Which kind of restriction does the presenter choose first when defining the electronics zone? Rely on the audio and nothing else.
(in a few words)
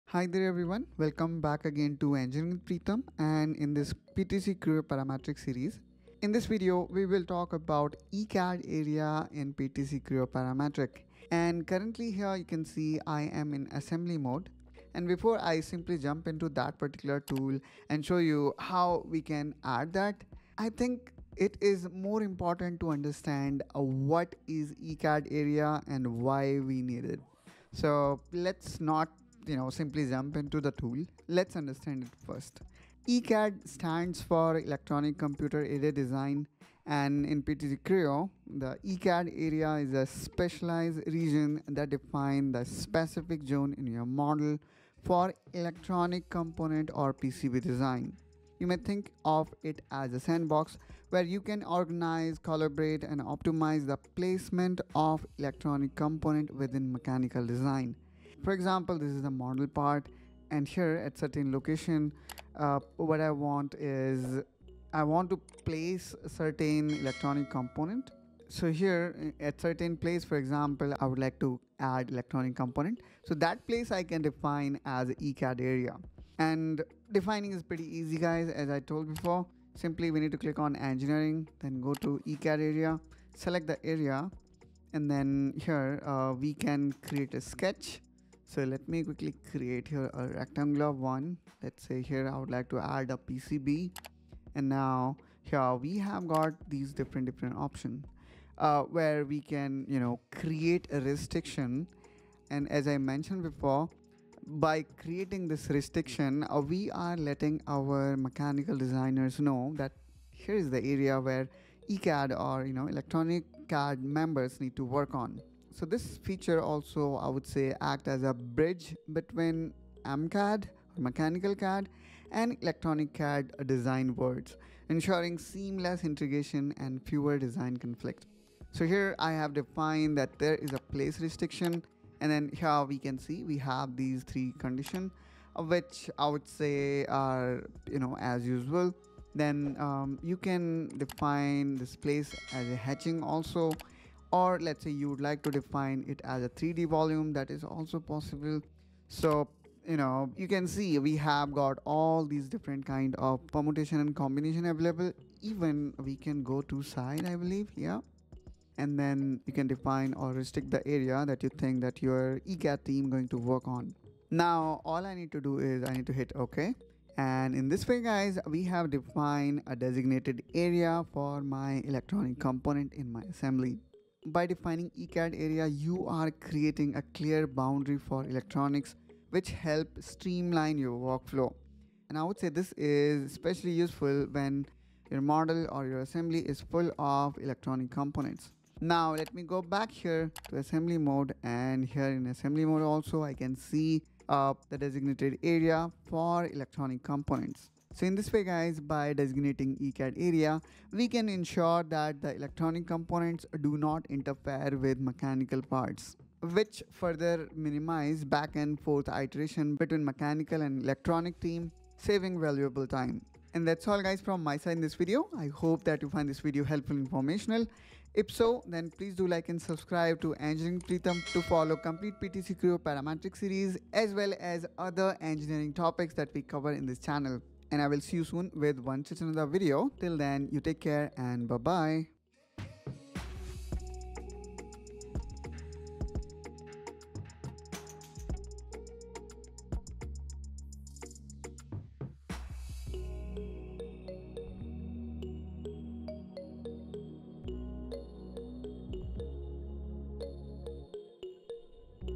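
Place restriction.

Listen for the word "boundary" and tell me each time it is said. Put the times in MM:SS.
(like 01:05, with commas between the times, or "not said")
02:57.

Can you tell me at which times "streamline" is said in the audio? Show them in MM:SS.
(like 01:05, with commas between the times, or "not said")
02:59.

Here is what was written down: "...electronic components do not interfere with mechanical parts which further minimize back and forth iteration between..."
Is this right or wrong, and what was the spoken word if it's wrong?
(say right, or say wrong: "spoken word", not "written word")
right.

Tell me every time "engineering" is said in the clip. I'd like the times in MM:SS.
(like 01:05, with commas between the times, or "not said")
00:02, 01:20, 03:40, 03:45.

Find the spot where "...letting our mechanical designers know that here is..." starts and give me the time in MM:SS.
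01:47.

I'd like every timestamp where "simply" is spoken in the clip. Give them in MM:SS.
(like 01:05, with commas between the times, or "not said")
00:15, 00:29, 01:19.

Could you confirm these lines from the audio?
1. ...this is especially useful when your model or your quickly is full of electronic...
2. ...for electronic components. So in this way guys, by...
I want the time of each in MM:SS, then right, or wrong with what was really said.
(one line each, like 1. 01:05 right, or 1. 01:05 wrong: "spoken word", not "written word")
1. 03:02 wrong: "assembly", not "quickly"
2. 03:16 right.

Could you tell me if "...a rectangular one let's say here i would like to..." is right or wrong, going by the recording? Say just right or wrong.
right.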